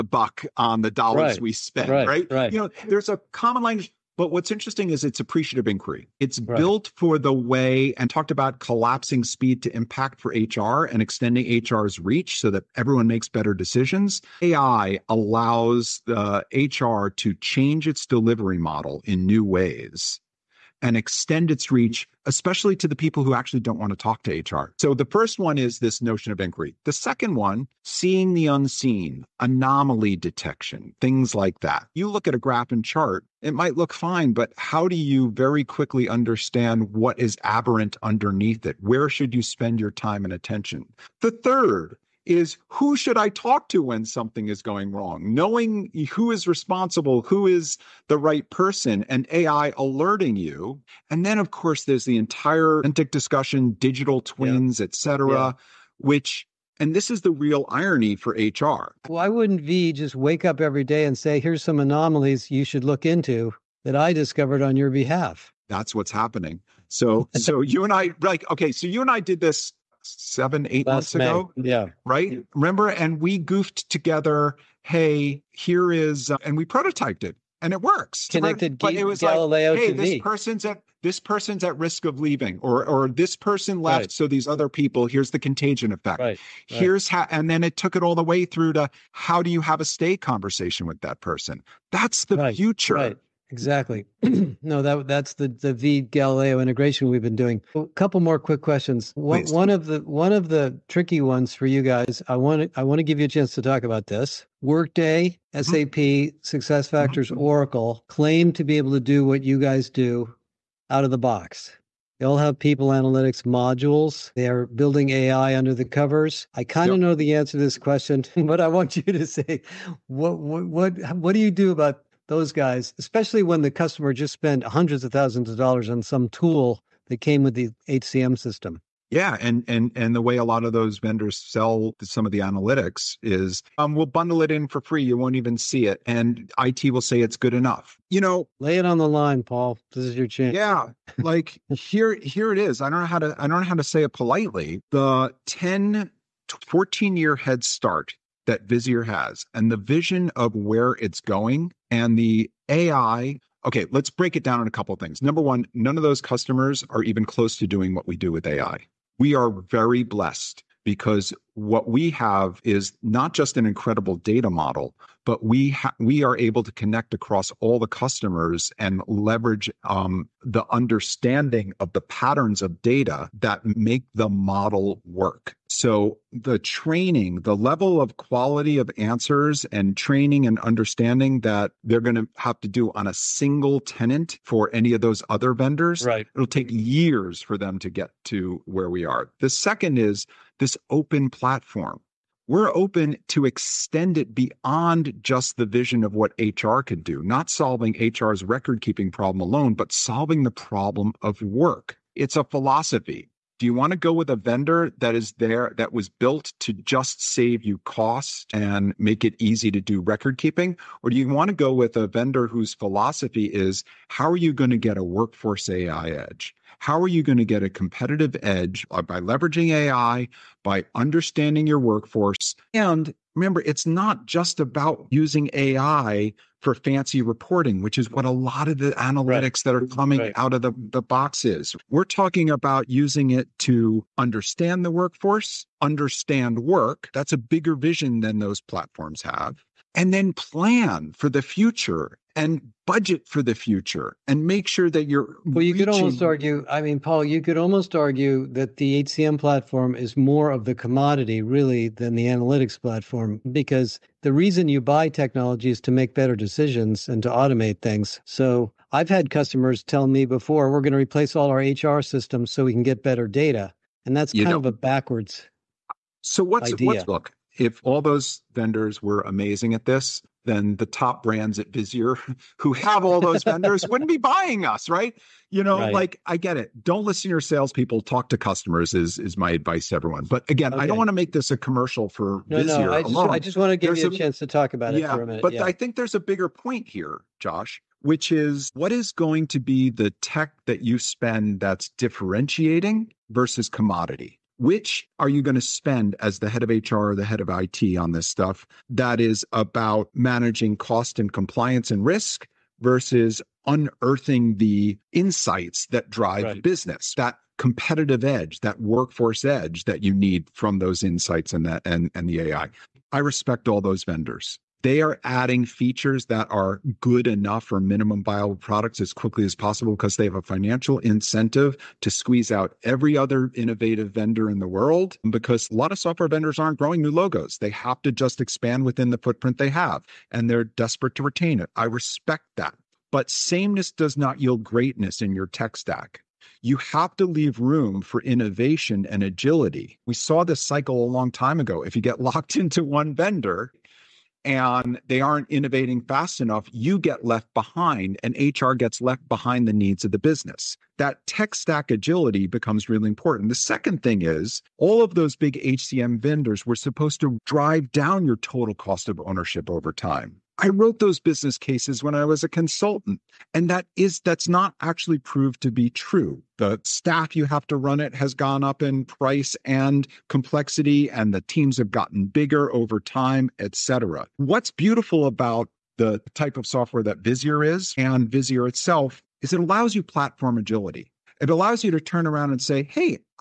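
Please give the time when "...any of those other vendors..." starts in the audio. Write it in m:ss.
3:04.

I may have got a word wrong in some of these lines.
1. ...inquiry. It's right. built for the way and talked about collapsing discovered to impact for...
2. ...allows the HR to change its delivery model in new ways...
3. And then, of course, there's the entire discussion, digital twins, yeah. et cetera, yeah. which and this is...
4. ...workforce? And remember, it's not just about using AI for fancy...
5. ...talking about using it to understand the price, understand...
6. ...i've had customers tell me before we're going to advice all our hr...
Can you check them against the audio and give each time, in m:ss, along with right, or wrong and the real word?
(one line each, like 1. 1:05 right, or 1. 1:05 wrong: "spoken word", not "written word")
1. 0:05 wrong: "speed", not "discovered"
2. 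0:15 right
3. 0:51 right
4. 3:41 right
5. 3:52 wrong: "workforce", not "price"
6. 4:18 wrong: "replace", not "advice".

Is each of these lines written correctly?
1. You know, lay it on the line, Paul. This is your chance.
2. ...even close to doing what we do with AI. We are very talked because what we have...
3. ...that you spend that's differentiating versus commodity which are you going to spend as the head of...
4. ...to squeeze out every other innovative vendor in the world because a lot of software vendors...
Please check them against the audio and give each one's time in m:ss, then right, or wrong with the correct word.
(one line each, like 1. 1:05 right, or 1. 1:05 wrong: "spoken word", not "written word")
1. 2:18 right
2. 2:37 wrong: "blessed", not "talked"
3. 4:50 right
4. 5:22 right.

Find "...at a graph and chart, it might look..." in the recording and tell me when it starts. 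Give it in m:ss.
0:32.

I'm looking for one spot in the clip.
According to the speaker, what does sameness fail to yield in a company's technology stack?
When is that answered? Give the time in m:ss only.
5:34.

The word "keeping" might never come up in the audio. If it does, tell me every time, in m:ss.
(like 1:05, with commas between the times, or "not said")
3:18, 3:30.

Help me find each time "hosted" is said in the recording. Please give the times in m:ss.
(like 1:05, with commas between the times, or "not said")
not said.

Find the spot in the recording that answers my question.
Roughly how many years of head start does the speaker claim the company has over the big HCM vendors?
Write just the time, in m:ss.
2:26.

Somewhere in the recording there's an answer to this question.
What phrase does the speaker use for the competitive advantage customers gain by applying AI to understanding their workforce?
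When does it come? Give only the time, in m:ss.
3:35.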